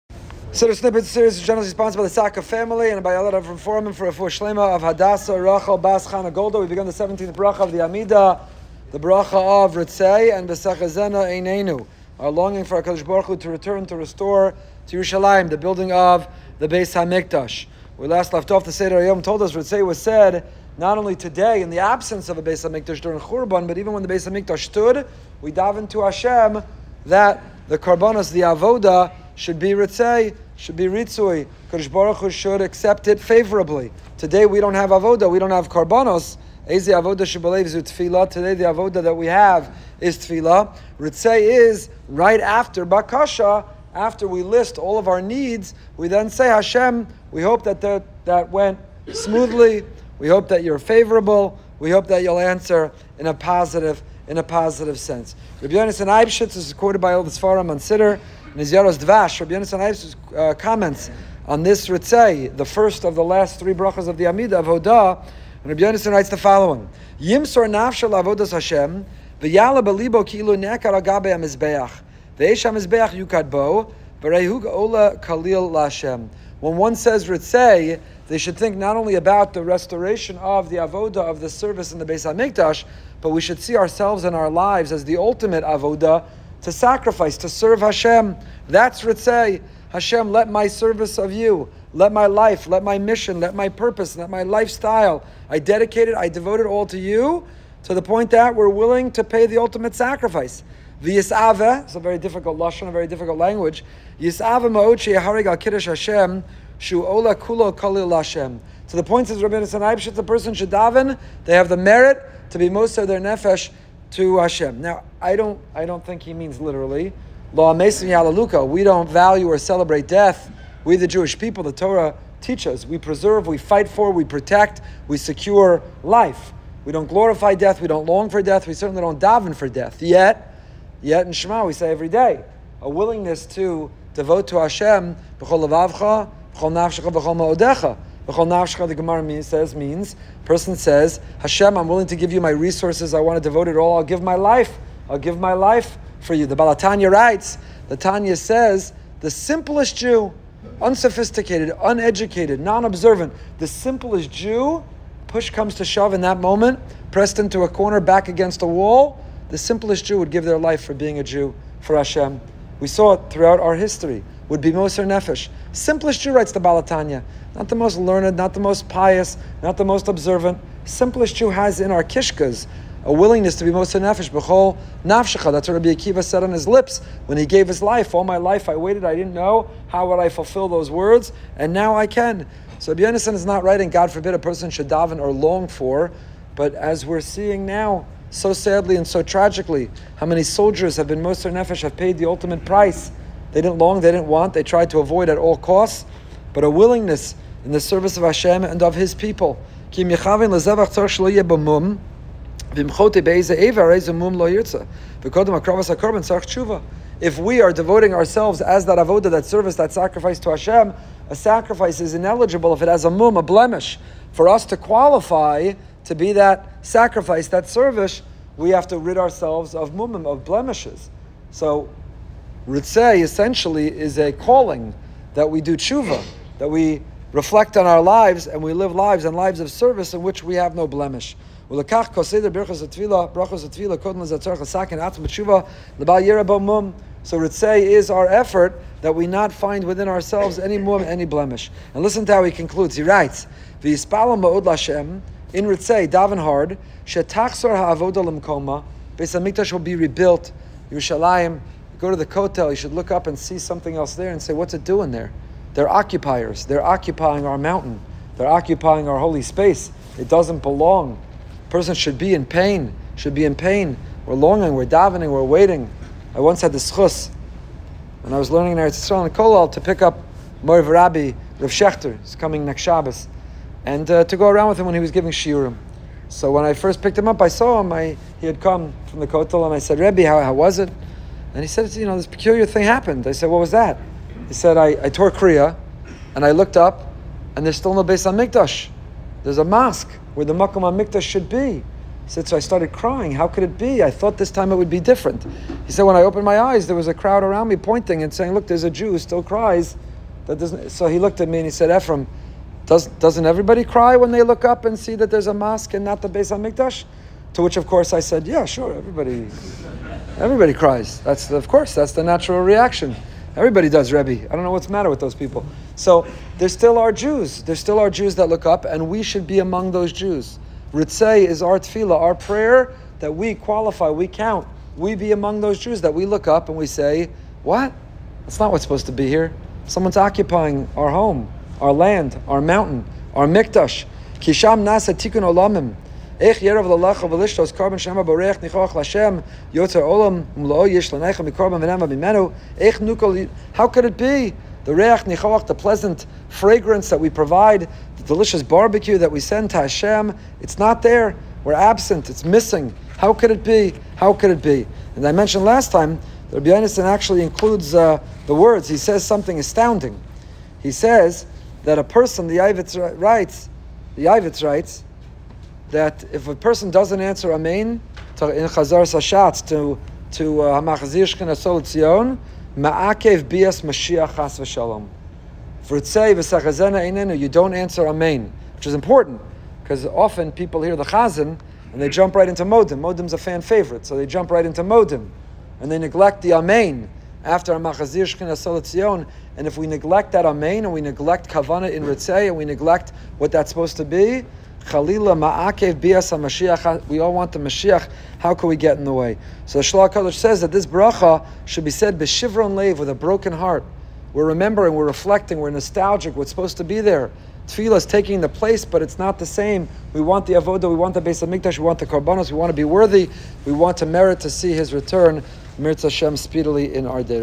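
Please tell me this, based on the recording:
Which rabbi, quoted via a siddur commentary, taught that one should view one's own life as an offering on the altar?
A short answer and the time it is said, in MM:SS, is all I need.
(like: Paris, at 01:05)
Rabbi Yonasan Eibschitz, at 00:55.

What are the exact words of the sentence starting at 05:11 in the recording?
That's the, of course that's the natural reaction.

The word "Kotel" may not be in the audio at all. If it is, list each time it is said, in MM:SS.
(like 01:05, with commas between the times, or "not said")
04:12, 04:39.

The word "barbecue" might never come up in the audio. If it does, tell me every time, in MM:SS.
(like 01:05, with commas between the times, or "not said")
05:48.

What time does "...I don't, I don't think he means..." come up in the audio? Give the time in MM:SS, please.
01:55.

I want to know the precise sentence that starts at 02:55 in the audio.
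That's what Rabbi Akiva said on his lips when he gave his life.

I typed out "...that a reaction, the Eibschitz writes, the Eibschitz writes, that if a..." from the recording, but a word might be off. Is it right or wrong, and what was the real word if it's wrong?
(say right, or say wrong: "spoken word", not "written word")
wrong: "person", not "reaction".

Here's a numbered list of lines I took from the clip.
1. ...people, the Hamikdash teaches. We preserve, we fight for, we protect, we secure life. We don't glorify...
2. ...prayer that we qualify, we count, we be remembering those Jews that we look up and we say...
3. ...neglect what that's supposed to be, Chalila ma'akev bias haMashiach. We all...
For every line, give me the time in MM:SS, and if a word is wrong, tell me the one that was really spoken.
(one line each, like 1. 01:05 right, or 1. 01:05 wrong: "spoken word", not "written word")
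1. 02:01 wrong: "Torah", not "Hamikdash"
2. 05:22 wrong: "among", not "remembering"
3. 06:32 right.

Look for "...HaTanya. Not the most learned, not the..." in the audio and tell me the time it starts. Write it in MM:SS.
02:46.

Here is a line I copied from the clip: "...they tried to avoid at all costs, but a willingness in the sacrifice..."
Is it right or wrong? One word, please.
wrong.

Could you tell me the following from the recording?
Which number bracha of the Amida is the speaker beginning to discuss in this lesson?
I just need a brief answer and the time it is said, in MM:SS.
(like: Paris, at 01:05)
17th, at 00:06.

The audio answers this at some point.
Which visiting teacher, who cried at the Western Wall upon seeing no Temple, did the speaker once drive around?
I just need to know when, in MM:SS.
04:31.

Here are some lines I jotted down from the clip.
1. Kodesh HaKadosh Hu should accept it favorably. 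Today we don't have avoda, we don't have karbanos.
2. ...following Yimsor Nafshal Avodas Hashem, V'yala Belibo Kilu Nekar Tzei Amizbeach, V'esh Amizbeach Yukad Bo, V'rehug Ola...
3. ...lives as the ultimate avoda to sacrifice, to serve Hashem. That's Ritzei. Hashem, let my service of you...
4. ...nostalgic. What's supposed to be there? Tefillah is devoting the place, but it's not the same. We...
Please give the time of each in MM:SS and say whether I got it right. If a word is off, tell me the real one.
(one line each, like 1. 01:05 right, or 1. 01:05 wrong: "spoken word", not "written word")
1. 00:31 wrong: "Baruch", not "HaKadosh"
2. 01:06 wrong: "Agabe", not "Tzei"
3. 01:24 right
4. 06:45 wrong: "taking", not "devoting".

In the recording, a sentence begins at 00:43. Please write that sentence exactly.
After we list all of our needs, we then say Hashem.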